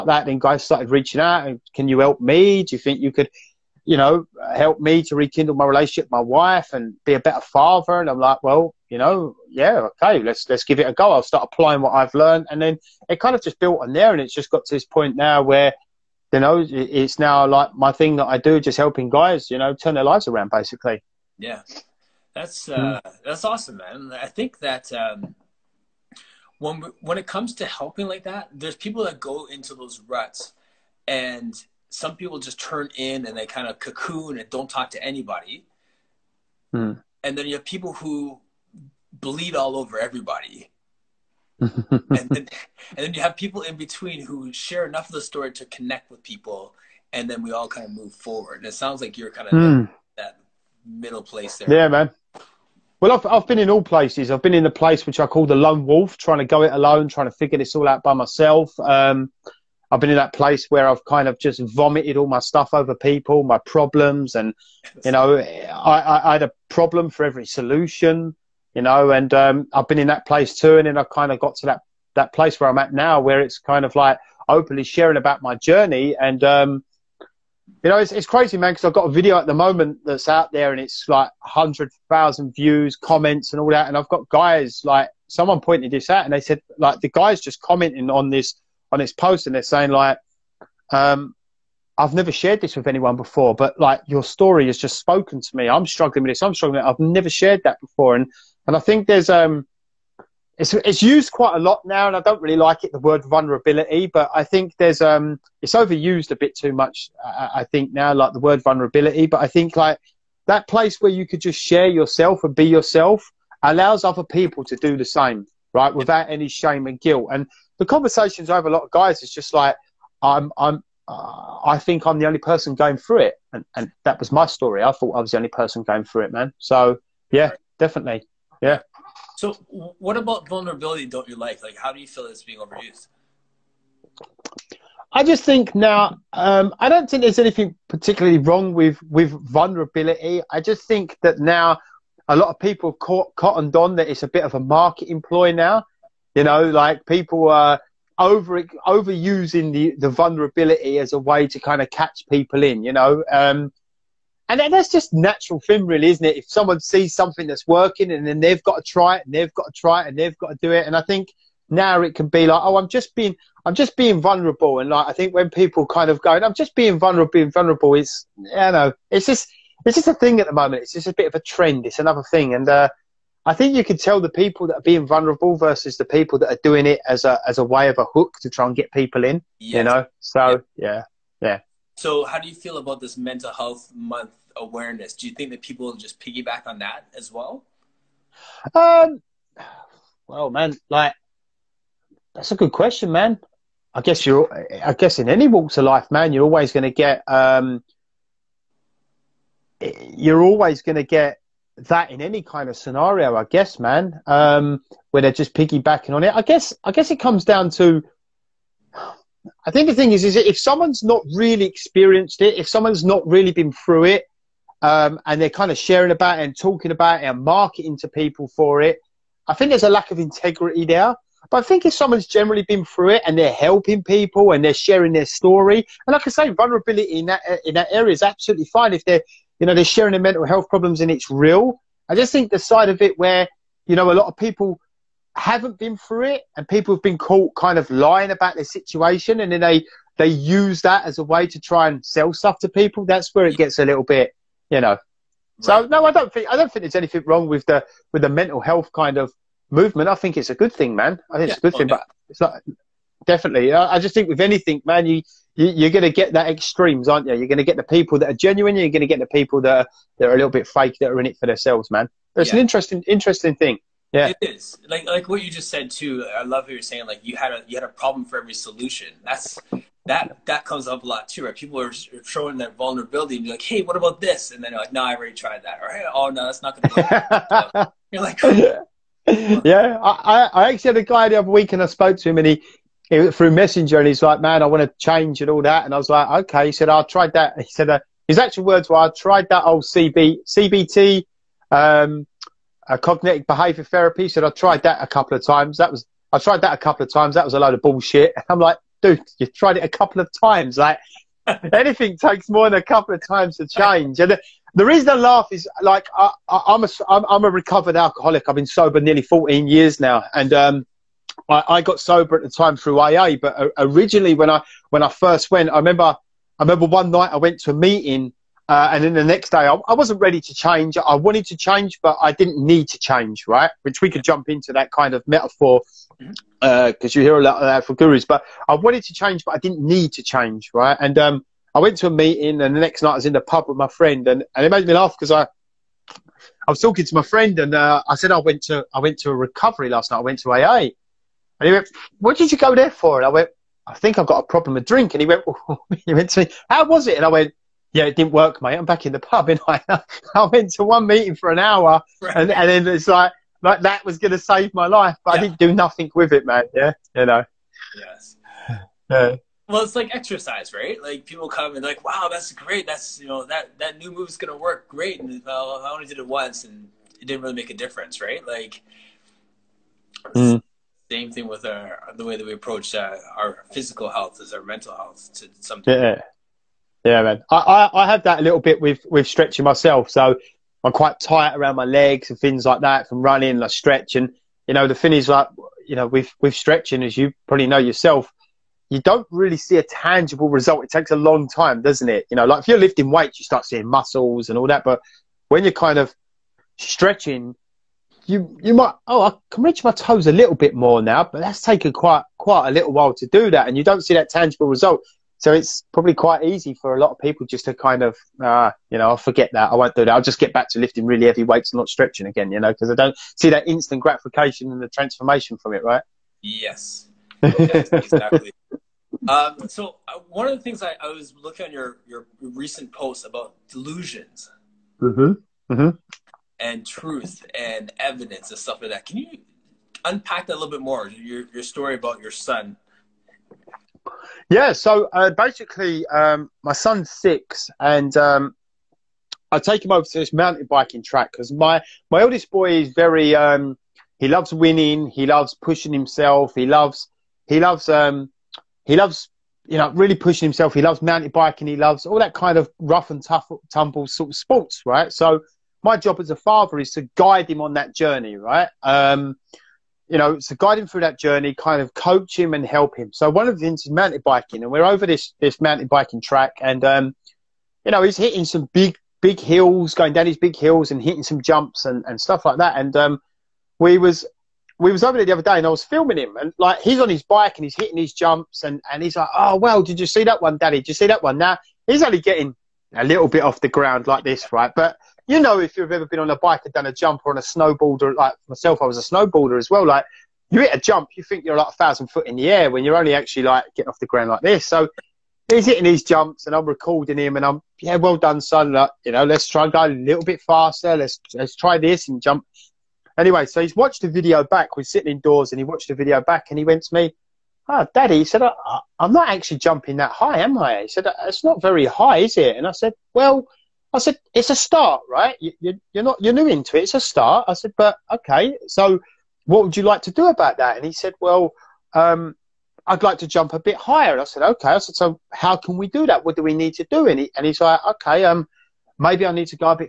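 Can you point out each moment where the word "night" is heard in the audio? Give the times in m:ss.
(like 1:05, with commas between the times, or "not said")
5:17, 5:33, 5:40.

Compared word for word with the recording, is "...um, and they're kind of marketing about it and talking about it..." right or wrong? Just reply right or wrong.
wrong.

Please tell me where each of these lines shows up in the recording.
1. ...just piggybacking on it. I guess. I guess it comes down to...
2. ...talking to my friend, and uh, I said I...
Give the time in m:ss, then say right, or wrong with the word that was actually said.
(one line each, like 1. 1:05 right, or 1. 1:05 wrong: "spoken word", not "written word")
1. 3:25 right
2. 5:36 right.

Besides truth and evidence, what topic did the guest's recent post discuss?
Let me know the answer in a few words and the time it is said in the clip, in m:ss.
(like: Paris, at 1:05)
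delusions, at 7:03.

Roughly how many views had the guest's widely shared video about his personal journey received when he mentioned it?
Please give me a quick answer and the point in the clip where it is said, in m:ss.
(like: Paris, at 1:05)
100,000, at 1:21.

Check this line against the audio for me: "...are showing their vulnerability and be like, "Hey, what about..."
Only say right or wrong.
right.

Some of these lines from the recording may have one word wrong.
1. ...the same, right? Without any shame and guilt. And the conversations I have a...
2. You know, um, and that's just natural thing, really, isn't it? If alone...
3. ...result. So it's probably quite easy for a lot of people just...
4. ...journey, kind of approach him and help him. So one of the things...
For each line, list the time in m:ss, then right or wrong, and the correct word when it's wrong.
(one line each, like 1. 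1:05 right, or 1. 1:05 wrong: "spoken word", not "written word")
1. 1:54 right
2. 2:32 wrong: "someone", not "alone"
3. 6:44 right
4. 7:41 wrong: "coach", not "approach".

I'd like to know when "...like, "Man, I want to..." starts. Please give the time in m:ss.
4:44.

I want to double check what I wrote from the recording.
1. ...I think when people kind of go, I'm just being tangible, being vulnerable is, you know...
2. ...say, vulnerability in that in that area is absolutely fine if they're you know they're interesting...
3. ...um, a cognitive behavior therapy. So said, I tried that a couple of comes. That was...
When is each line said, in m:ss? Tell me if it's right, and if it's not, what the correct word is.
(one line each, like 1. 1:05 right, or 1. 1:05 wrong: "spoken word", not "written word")
1. 2:45 wrong: "vulnerable", not "tangible"
2. 3:46 wrong: "sharing", not "interesting"
3. 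4:51 wrong: "times", not "comes".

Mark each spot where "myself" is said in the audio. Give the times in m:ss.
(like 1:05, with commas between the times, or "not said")
0:58, 6:19, 8:08.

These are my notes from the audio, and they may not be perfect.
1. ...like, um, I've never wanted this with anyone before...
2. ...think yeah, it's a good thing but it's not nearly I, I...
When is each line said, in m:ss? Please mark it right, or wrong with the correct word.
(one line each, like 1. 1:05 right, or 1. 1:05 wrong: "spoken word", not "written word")
1. 1:29 wrong: "shared", not "wanted"
2. 4:11 wrong: "definitely", not "nearly".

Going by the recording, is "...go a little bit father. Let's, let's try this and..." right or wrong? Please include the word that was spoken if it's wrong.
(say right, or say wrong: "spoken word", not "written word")
wrong: "faster", not "father".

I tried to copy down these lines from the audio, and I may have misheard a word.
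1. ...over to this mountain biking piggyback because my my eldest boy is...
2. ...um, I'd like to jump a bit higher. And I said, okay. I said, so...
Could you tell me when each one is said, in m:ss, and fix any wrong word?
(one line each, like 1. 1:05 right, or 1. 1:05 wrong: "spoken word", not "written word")
1. 7:19 wrong: "track", not "piggyback"
2. 8:41 right.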